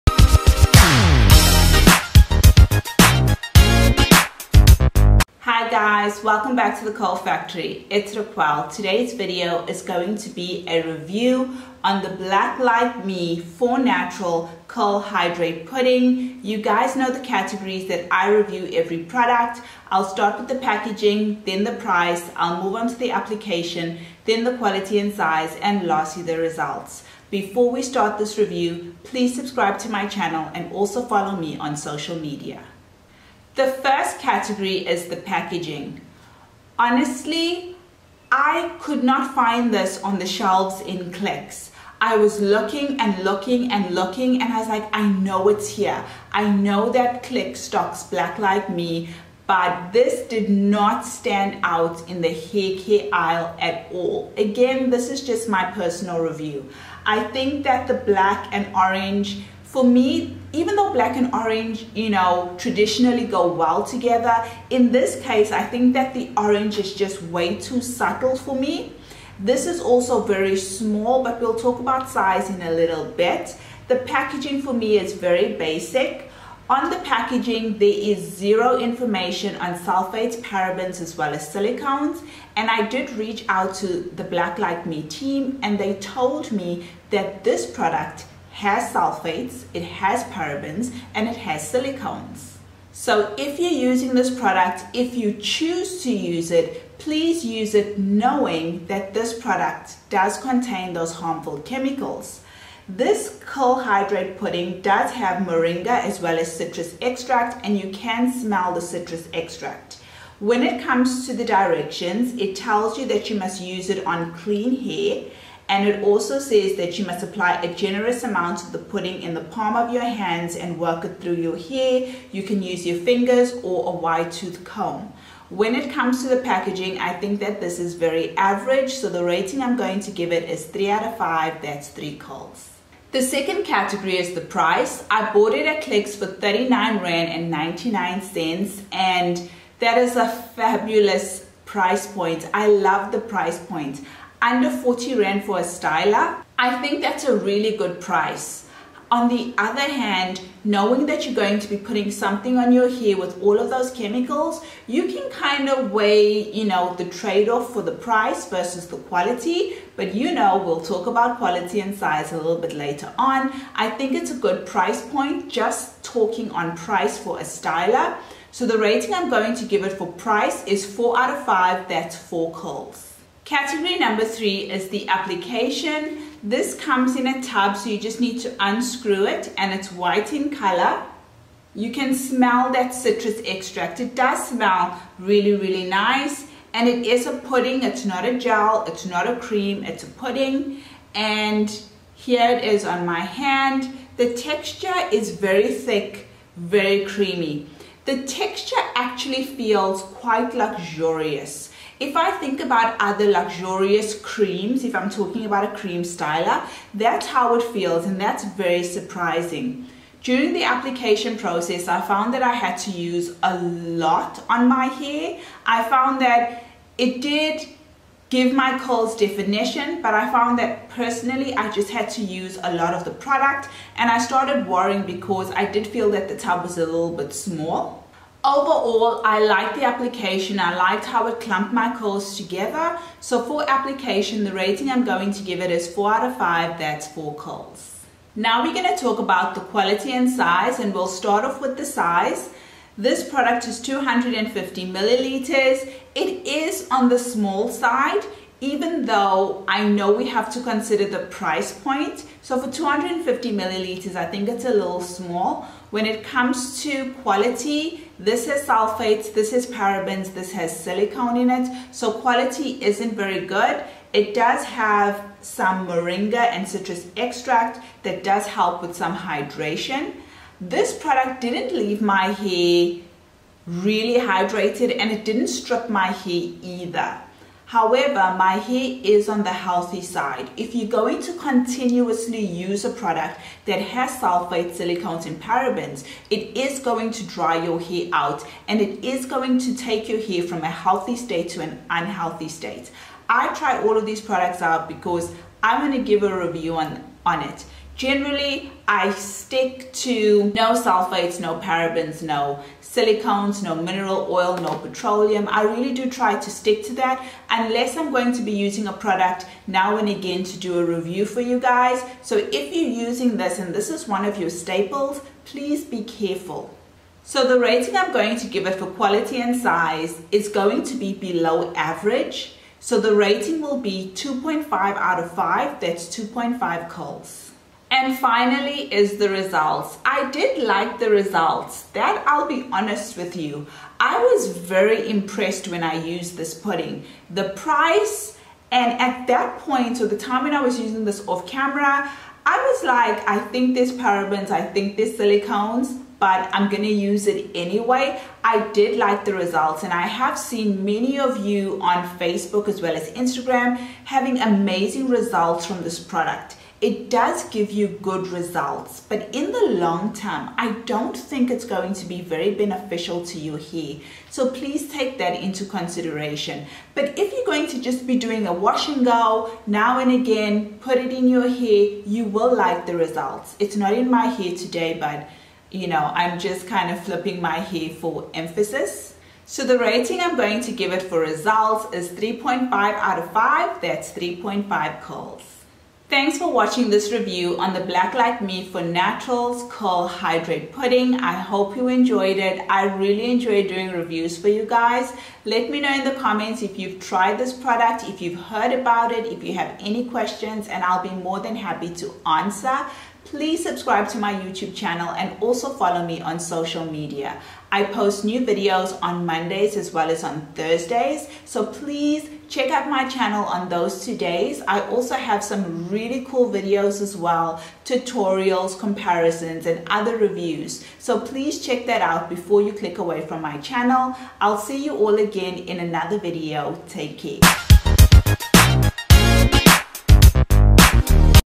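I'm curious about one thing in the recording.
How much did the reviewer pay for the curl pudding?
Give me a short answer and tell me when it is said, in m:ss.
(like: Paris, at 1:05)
39 Rand and 99 cents, at 2:16.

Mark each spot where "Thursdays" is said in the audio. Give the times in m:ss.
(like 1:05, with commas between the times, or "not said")
6:50.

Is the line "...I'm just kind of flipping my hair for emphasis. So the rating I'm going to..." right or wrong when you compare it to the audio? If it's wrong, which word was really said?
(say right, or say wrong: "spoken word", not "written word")
right.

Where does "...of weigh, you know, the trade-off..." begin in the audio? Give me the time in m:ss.
2:35.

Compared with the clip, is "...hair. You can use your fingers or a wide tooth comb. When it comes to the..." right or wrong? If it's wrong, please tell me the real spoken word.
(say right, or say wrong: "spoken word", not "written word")
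right.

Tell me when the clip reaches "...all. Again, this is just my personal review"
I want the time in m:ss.
0:53.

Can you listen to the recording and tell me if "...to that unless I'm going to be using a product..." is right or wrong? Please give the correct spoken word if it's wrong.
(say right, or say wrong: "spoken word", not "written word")
right.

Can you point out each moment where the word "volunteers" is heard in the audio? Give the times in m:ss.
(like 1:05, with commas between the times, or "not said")
not said.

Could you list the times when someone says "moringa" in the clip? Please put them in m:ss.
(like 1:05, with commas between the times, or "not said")
1:45, 4:25.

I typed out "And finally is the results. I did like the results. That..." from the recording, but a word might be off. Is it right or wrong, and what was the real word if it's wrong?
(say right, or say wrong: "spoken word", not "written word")
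right.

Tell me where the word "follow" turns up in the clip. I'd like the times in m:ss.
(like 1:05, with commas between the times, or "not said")
0:31, 6:45.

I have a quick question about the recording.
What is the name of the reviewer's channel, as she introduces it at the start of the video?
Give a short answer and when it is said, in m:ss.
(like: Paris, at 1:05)
Curl Factory, at 0:06.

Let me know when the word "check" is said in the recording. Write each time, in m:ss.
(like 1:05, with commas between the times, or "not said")
6:52, 7:01.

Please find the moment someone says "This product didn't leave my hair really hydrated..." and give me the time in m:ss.
4:30.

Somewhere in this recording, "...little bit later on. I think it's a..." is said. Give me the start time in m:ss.
2:42.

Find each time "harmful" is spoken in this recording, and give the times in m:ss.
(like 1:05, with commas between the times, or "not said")
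1:41.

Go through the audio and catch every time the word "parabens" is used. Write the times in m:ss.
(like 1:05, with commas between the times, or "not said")
1:20, 1:30, 4:19, 4:45, 5:01, 5:43.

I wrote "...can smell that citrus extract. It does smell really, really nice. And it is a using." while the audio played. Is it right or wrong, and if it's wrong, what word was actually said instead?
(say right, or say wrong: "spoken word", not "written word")
wrong: "pudding", not "using".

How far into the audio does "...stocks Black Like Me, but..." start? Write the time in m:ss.
0:47.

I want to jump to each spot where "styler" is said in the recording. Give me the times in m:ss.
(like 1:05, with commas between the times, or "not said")
2:25, 2:47, 3:26.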